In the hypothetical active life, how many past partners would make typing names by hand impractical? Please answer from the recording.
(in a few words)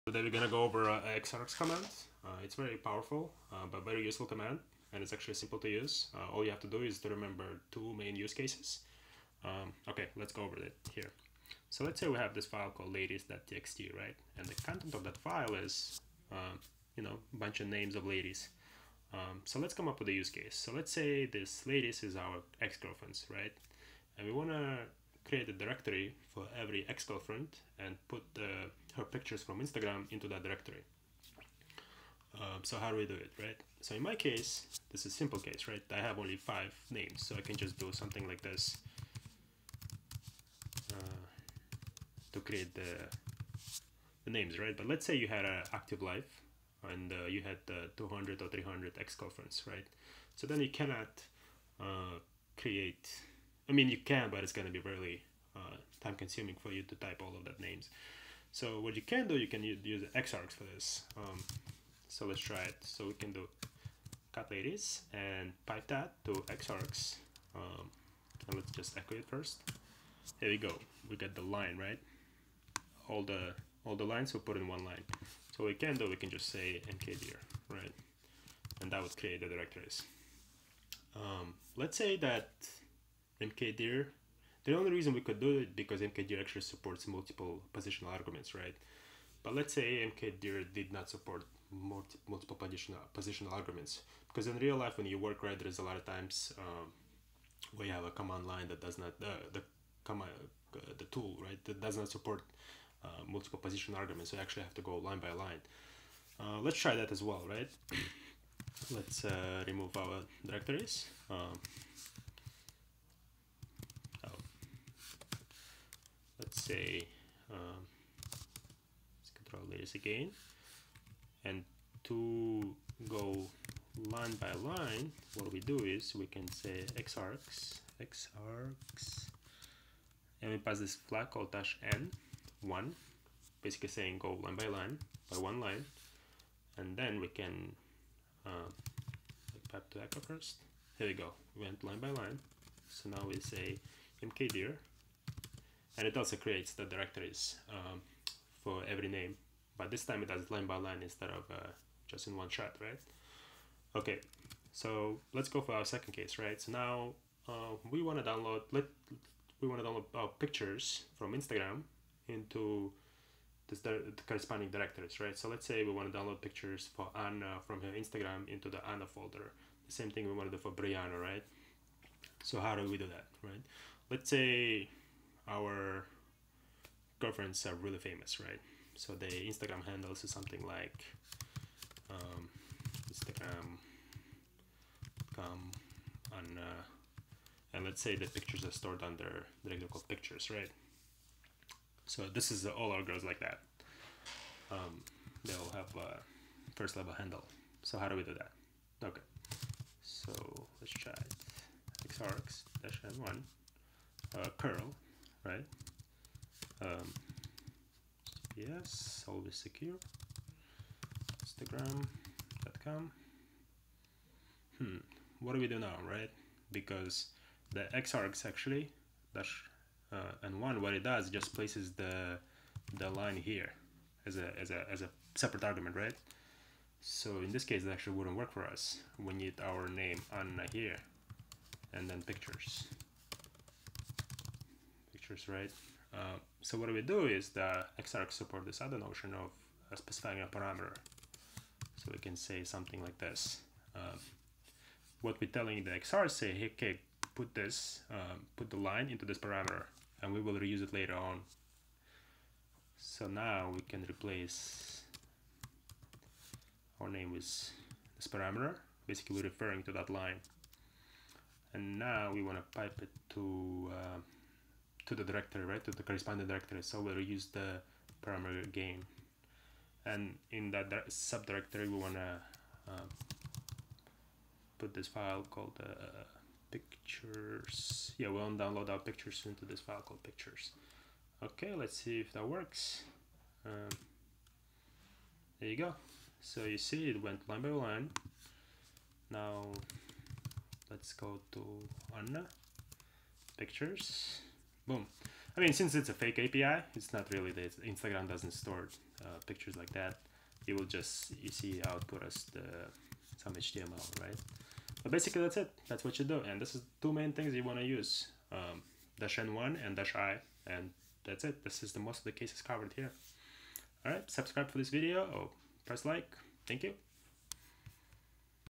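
300.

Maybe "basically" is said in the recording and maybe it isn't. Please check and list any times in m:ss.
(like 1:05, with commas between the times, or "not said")
2:13, 4:19, 5:05.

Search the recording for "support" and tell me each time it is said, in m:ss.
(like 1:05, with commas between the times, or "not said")
1:26, 1:31, 1:42, 3:58.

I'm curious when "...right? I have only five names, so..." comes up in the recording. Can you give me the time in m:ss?
0:35.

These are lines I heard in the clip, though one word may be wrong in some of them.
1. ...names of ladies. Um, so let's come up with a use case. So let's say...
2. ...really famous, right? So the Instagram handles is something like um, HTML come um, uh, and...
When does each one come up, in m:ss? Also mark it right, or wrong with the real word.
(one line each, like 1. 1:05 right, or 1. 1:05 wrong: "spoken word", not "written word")
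1. 0:17 right
2. 2:57 wrong: "Instagram", not "HTML".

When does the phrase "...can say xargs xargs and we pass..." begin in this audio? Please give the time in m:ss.
2:06.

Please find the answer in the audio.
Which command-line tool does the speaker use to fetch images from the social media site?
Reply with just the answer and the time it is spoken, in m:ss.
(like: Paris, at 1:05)
curl, at 3:24.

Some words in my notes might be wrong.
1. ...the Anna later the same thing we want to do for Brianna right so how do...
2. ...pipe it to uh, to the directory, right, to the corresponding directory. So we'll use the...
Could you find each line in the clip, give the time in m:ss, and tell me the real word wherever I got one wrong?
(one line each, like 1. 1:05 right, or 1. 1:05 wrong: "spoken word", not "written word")
1. 2:48 wrong: "folder", not "later"
2. 4:22 right.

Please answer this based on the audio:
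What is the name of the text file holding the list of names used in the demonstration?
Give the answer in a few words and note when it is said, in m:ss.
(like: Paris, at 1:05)
ladies.txt, at 0:12.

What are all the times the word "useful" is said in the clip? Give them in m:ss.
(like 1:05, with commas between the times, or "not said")
0:04.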